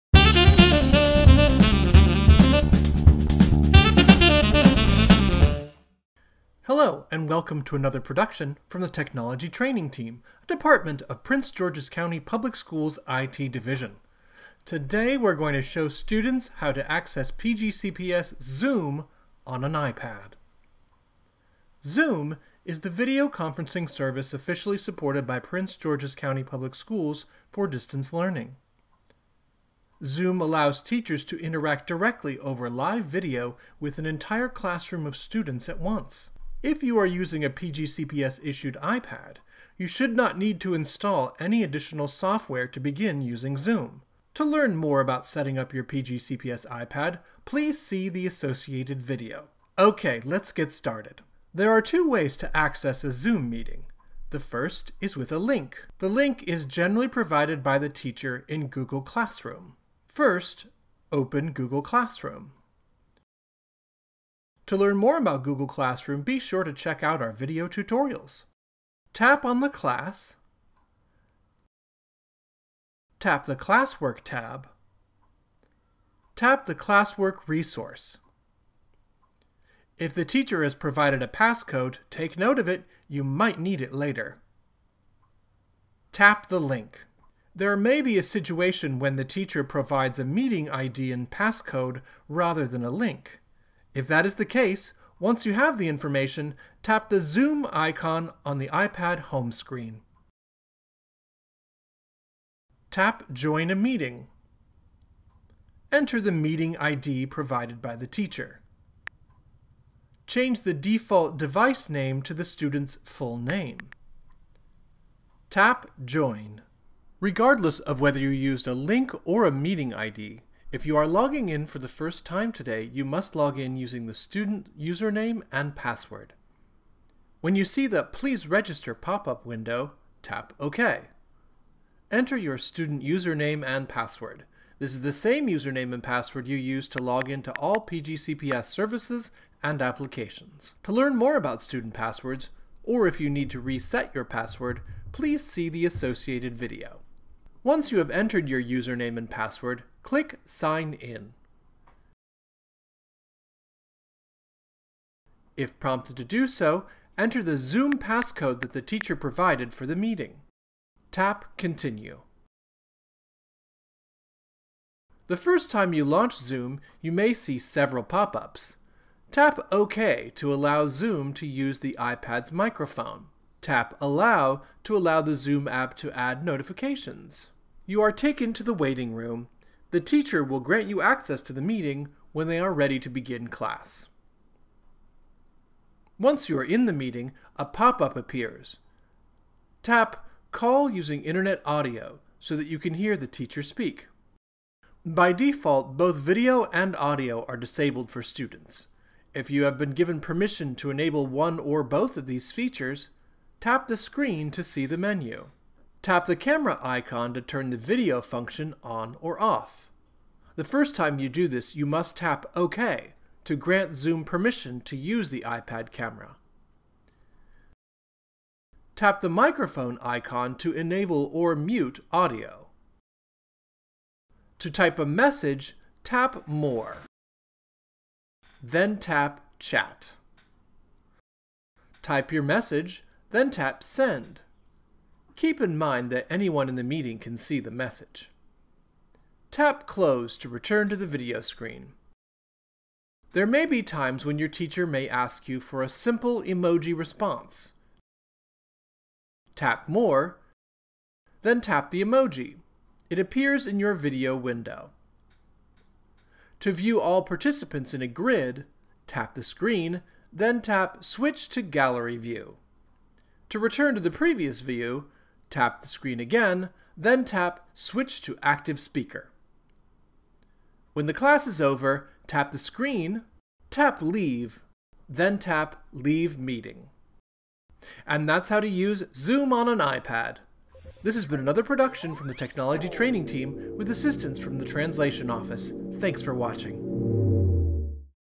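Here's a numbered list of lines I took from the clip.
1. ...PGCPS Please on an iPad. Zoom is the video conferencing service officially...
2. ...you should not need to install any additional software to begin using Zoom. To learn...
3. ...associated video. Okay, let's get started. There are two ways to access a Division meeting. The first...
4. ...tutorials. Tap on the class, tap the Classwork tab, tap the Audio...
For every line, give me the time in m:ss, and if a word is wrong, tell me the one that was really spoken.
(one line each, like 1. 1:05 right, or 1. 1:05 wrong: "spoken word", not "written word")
1. 0:17 wrong: "Zoom", not "Please"
2. 0:39 right
3. 0:48 wrong: "Zoom", not "Division"
4. 1:07 wrong: "Classwork", not "Audio".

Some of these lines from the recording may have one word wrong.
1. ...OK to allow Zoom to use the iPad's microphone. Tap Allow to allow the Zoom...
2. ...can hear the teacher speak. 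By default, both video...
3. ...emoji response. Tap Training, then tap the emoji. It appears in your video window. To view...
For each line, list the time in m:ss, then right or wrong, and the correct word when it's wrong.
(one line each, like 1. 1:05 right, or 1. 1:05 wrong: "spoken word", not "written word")
1. 2:49 right
2. 3:12 right
3. 4:06 wrong: "More", not "Training".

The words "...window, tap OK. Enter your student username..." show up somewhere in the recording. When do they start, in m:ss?
2:09.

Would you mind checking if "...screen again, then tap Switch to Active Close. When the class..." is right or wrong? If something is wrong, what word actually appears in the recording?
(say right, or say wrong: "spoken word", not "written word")
wrong: "Speaker", not "Close".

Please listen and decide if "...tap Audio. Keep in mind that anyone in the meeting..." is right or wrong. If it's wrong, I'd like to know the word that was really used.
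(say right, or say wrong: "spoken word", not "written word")
wrong: "Send", not "Audio".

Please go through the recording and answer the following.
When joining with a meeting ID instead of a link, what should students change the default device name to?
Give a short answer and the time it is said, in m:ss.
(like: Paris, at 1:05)
the student's full name, at 1:52.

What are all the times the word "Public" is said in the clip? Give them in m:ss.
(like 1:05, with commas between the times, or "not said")
0:12, 0:26.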